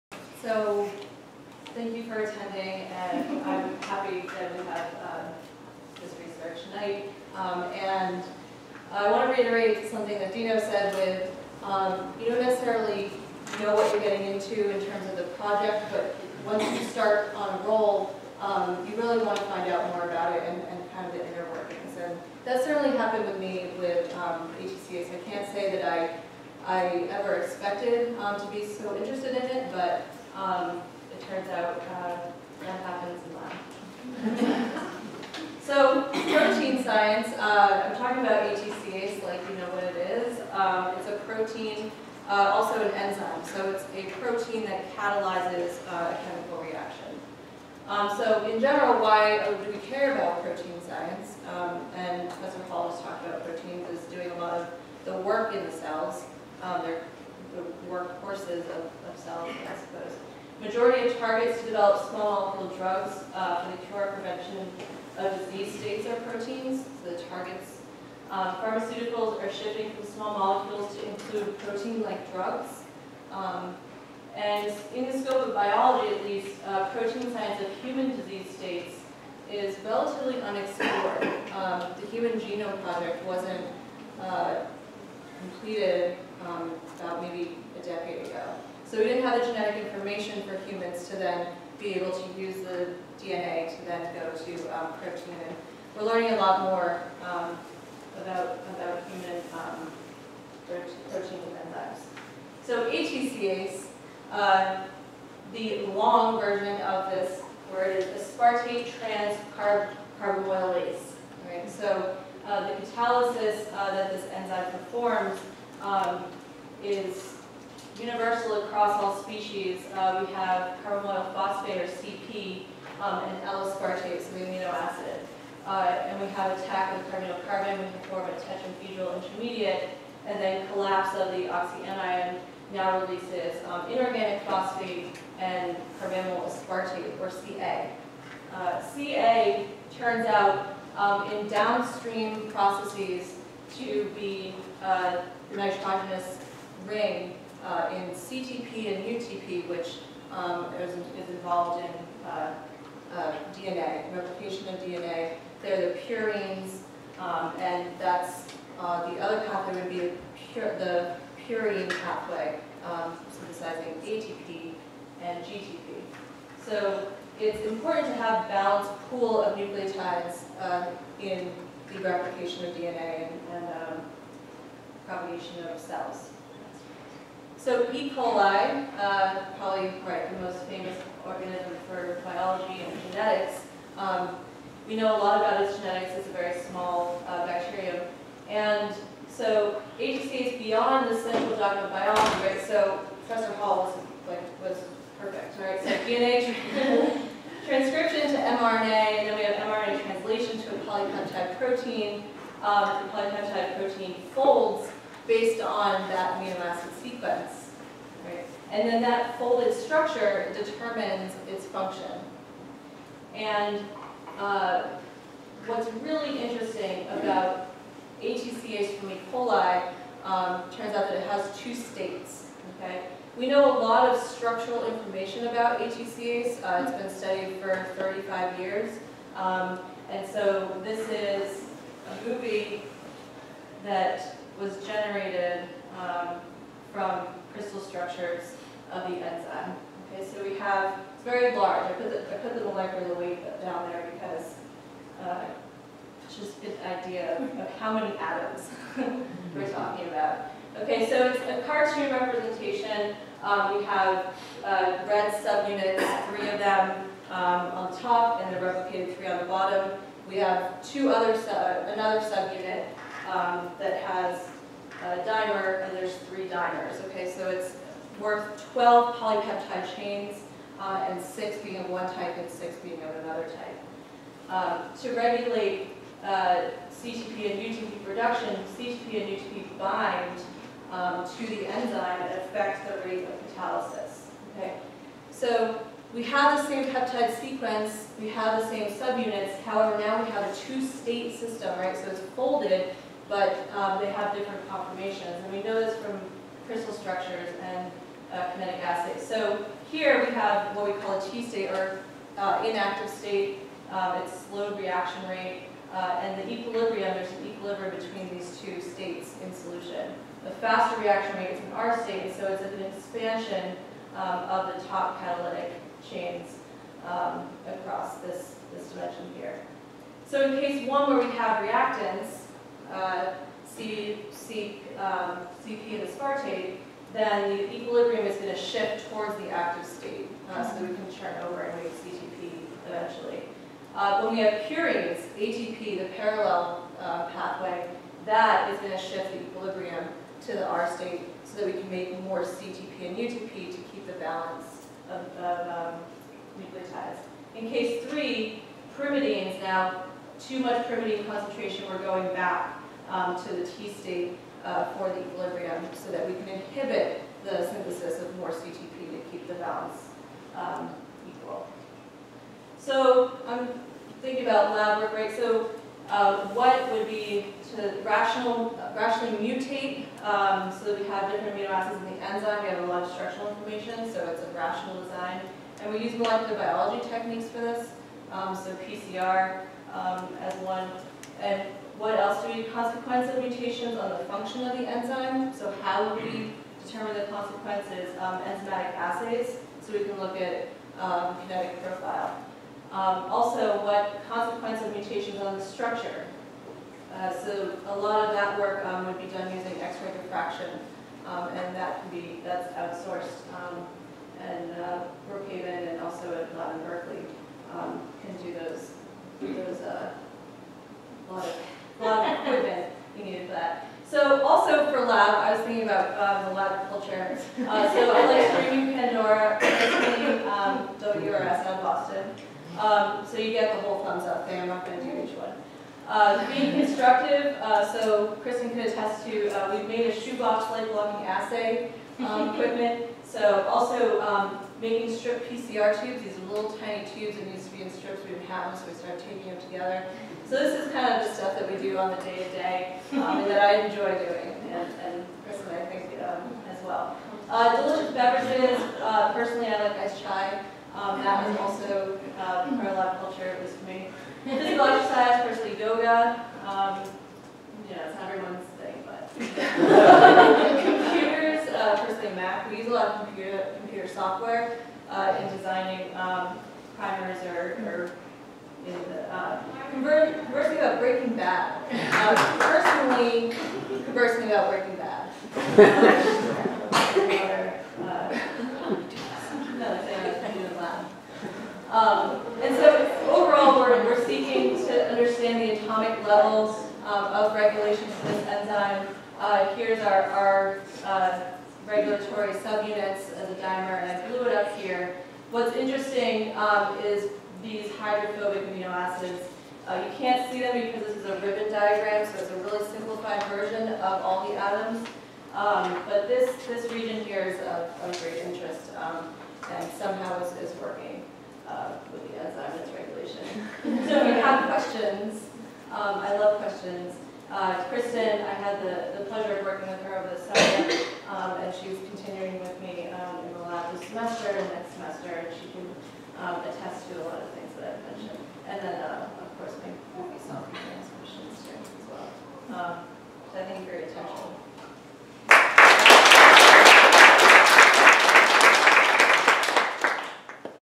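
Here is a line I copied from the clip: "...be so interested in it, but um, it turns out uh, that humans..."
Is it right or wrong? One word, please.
wrong.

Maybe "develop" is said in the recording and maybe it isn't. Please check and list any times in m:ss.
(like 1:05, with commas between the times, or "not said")
1:01.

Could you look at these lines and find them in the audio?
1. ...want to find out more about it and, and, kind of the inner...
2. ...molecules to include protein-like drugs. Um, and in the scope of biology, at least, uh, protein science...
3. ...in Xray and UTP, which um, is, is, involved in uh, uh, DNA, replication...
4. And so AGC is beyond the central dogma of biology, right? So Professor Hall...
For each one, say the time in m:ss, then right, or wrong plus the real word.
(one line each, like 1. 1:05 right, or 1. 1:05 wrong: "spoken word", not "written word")
1. 0:19 right
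2. 1:10 right
3. 2:27 wrong: "CTP", not "Xray"
4. 3:08 right.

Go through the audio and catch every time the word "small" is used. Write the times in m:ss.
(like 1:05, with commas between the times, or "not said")
1:02, 1:10, 3:06.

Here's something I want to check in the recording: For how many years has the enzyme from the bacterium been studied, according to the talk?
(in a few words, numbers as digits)
35.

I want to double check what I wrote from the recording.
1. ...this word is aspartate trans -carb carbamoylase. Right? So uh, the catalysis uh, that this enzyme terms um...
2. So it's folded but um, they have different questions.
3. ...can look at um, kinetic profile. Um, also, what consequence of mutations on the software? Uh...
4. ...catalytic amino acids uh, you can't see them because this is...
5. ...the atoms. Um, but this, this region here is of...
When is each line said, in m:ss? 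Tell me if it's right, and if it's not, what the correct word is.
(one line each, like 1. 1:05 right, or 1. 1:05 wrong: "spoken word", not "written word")
1. 1:47 wrong: "performs", not "terms"
2. 4:51 wrong: "conformations", not "questions"
3. 6:30 wrong: "structure", not "software"
4. 8:17 wrong: "hydrophobic", not "catalytic"
5. 8:24 right.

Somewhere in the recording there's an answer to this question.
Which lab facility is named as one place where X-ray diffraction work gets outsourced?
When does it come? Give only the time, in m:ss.
6:45.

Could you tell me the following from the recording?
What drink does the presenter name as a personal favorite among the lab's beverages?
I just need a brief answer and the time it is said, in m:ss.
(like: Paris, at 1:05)
iced chai, at 7:29.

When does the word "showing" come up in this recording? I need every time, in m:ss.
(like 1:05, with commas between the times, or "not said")
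not said.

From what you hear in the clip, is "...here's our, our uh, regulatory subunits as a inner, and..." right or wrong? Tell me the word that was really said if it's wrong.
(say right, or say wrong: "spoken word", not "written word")
wrong: "dimer", not "inner".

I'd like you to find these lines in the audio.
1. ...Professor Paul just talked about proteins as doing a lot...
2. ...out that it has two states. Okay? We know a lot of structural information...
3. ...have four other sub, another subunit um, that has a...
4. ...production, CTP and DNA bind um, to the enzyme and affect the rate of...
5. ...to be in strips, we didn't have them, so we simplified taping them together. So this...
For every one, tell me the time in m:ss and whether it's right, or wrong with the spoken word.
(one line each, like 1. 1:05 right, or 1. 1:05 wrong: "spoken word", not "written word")
1. 0:52 right
2. 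3:40 right
3. 4:20 wrong: "two", not "four"
4. 4:38 wrong: "UTP", not "DNA"
5. 7:17 wrong: "started", not "simplified".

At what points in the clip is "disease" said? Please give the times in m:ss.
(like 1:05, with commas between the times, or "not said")
1:05, 1:18.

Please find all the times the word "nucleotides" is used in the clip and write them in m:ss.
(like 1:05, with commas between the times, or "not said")
2:49, 5:46.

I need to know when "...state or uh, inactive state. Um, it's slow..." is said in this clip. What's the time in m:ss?
5:01.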